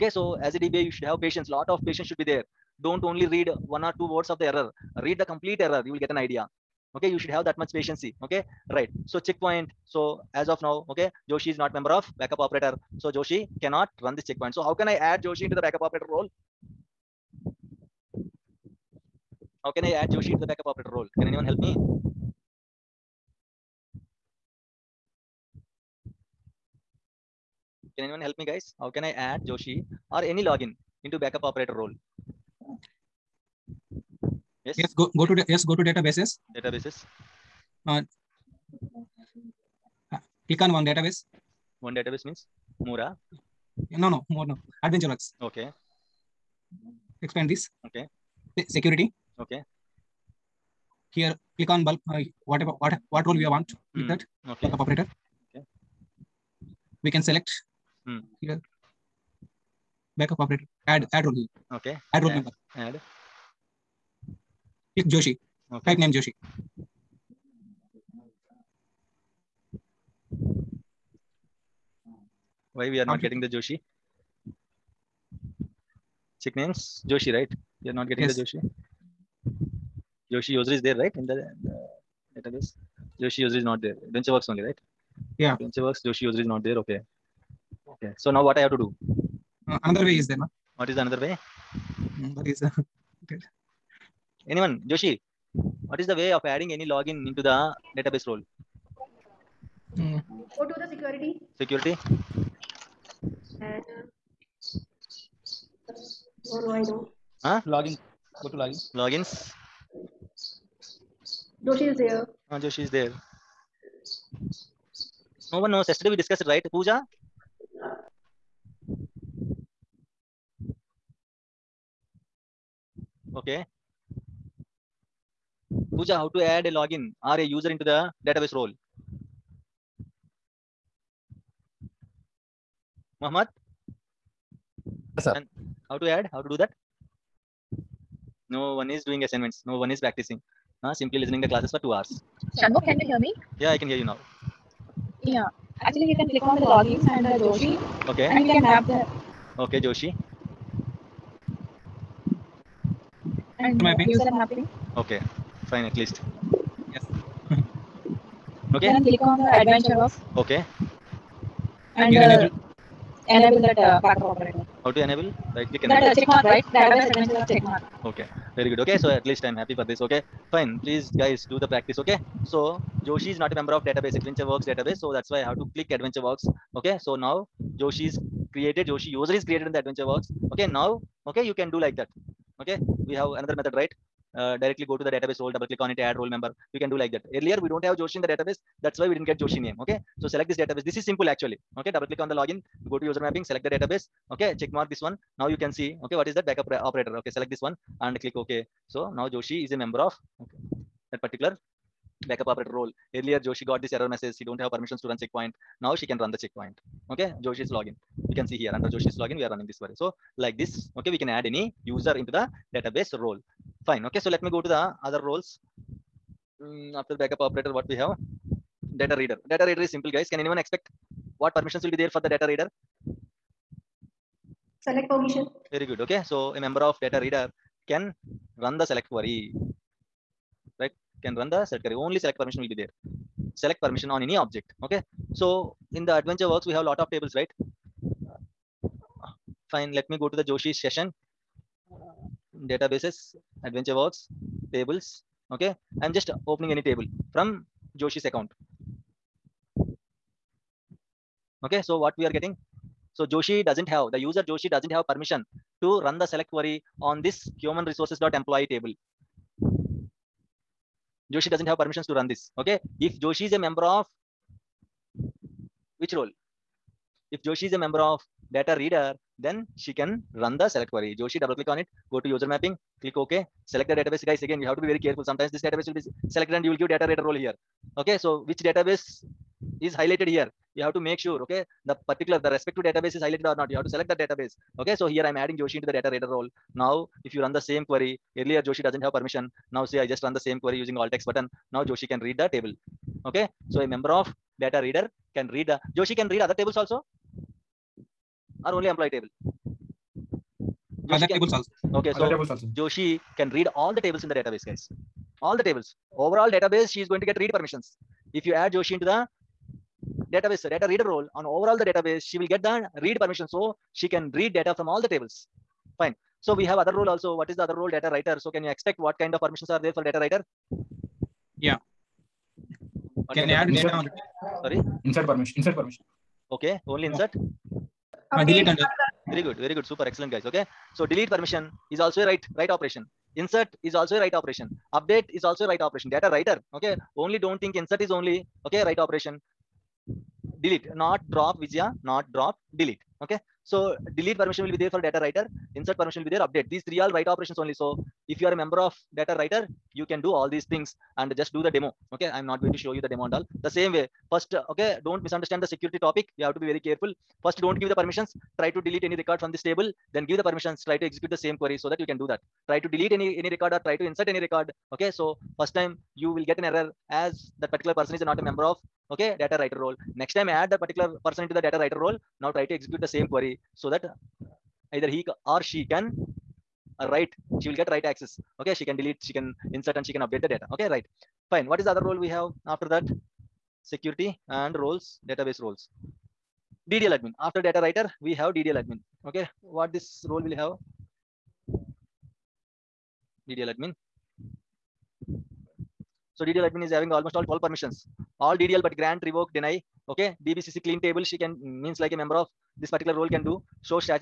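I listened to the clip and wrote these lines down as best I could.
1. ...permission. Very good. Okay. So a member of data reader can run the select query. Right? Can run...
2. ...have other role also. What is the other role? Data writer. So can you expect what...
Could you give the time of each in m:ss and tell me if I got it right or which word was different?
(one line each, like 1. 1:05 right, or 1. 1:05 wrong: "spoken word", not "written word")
1. 3:45 right
2. 5:16 right.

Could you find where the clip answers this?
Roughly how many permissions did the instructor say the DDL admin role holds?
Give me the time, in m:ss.
6:37.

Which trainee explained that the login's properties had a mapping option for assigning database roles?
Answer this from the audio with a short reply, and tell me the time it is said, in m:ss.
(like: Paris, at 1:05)
Shanmukh, at 2:22.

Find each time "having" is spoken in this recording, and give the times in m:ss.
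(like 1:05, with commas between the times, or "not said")
6:36.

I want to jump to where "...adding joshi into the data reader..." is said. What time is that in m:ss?
4:45.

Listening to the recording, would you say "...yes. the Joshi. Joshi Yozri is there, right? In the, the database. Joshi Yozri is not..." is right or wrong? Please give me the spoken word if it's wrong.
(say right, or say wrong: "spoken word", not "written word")
right.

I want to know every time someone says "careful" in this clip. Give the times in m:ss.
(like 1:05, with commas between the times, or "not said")
4:34, 5:56.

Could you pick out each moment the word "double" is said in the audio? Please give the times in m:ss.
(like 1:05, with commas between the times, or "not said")
3:05, 3:11, 4:31.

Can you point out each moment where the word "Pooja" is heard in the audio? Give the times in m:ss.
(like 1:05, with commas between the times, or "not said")
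1:56, 2:05.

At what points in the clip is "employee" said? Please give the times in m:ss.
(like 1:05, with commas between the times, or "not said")
4:18, 4:58.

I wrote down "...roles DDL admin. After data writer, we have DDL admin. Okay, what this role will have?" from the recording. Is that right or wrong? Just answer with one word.
right.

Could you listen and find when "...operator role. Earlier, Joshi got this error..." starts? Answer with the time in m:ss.
3:22.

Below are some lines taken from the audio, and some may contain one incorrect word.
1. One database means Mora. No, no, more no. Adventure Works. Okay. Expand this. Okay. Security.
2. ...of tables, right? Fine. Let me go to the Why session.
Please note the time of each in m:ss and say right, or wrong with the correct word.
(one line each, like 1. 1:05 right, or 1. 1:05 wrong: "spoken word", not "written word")
1. 0:41 right
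2. 3:56 wrong: "Joshi", not "Why".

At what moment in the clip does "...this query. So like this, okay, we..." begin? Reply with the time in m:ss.
3:29.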